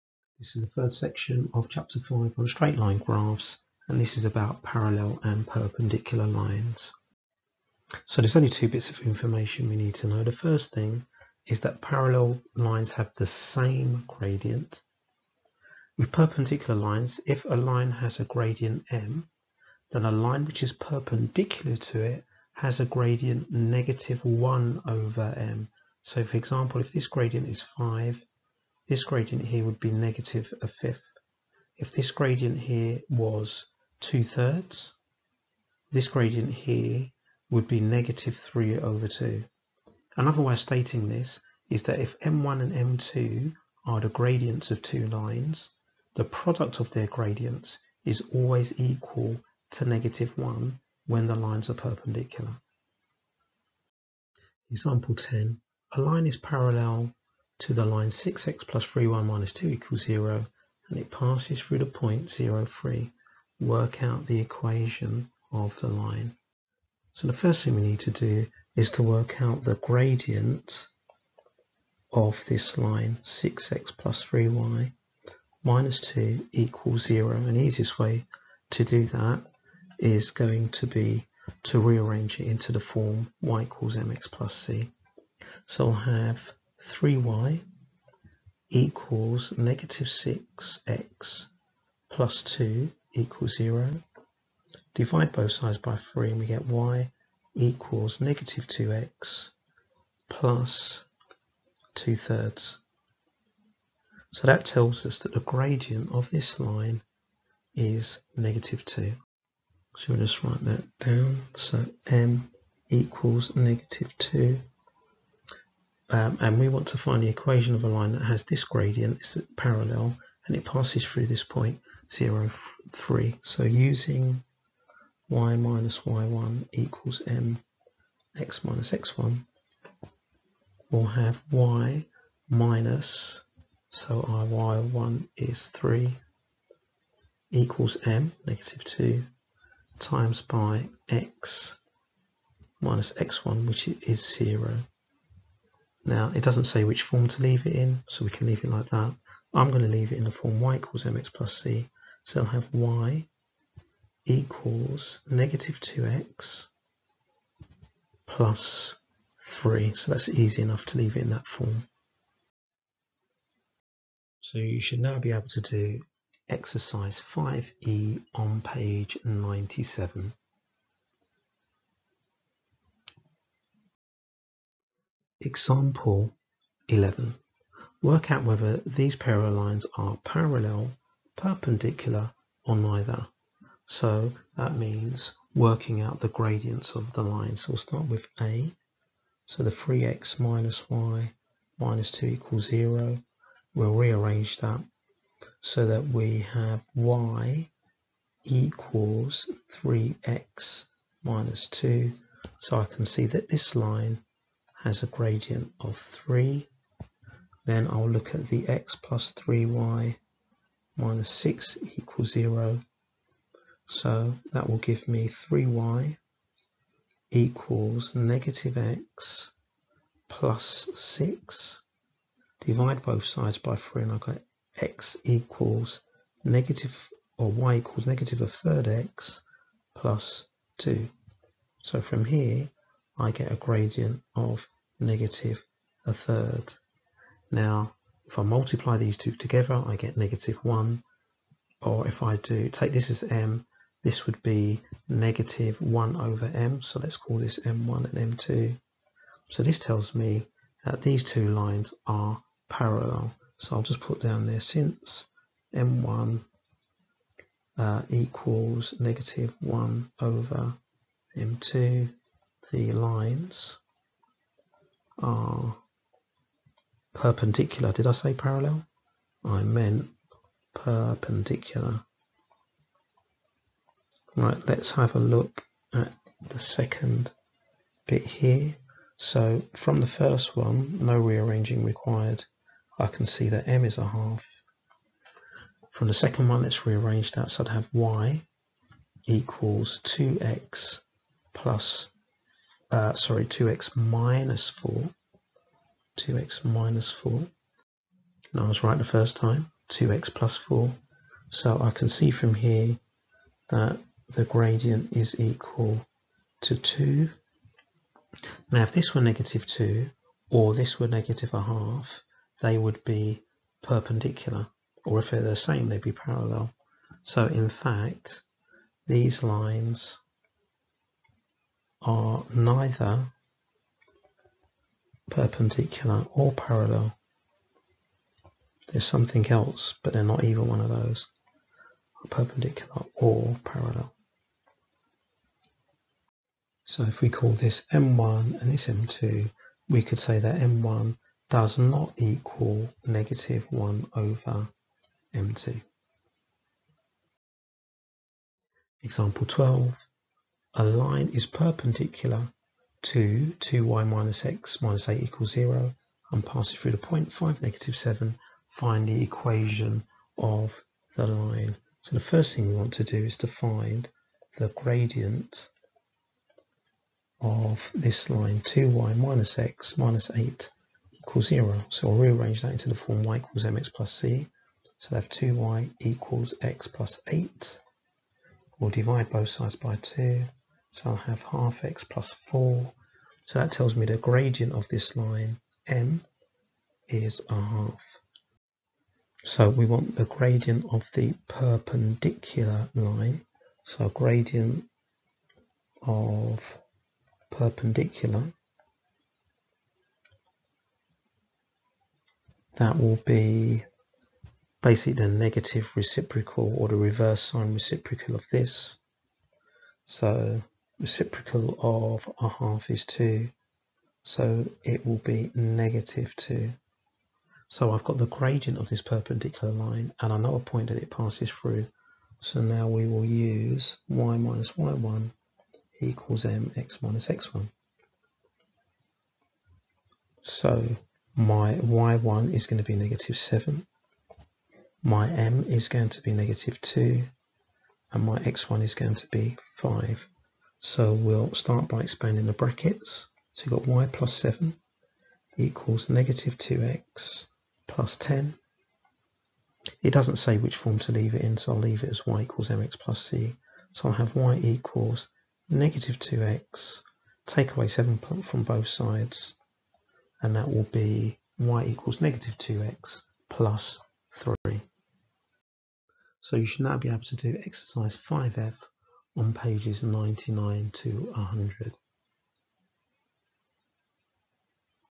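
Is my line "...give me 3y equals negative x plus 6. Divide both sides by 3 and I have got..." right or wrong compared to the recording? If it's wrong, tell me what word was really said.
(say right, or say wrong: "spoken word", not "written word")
right.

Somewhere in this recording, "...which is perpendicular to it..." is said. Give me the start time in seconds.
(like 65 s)
20 s.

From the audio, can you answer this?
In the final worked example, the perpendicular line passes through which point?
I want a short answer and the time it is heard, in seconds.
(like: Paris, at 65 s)
(5, -7), at 357 s.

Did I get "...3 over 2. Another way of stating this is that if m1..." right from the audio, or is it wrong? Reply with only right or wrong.
right.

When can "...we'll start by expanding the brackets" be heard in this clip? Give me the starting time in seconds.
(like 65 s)
441 s.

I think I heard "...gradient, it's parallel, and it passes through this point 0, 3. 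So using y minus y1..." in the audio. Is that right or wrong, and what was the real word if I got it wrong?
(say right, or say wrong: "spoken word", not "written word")
right.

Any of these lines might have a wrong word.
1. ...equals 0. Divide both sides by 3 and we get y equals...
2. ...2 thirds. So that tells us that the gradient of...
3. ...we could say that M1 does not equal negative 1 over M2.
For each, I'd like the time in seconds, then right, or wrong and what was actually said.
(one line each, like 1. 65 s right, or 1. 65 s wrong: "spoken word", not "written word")
1. 93 s right
2. 101 s right
3. 339 s right.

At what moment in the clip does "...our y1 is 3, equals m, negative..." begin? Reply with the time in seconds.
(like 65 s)
134 s.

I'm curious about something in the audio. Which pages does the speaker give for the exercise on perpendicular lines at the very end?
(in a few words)
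99 to 100.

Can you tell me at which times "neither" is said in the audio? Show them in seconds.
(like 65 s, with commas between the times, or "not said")
182 s, 322 s.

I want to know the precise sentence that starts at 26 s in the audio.
So for example, if this gradient is 5, this gradient here would be negative a fifth.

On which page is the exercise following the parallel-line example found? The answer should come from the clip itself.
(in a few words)
97.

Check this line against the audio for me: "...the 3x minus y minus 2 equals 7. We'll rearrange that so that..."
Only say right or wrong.
wrong.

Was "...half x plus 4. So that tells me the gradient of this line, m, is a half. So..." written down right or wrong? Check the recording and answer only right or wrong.
right.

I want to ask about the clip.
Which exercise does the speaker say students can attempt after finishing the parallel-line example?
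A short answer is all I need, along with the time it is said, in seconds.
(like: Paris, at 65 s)
Exercise 5e, at 166 s.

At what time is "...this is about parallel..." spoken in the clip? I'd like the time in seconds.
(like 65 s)
4 s.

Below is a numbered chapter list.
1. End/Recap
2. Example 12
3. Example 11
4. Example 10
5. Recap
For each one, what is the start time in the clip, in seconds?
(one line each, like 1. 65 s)
1. 466 s
2. 347 s
3. 173 s
4. 53 s
5. 163 s.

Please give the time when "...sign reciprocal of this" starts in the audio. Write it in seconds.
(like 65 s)
407 s.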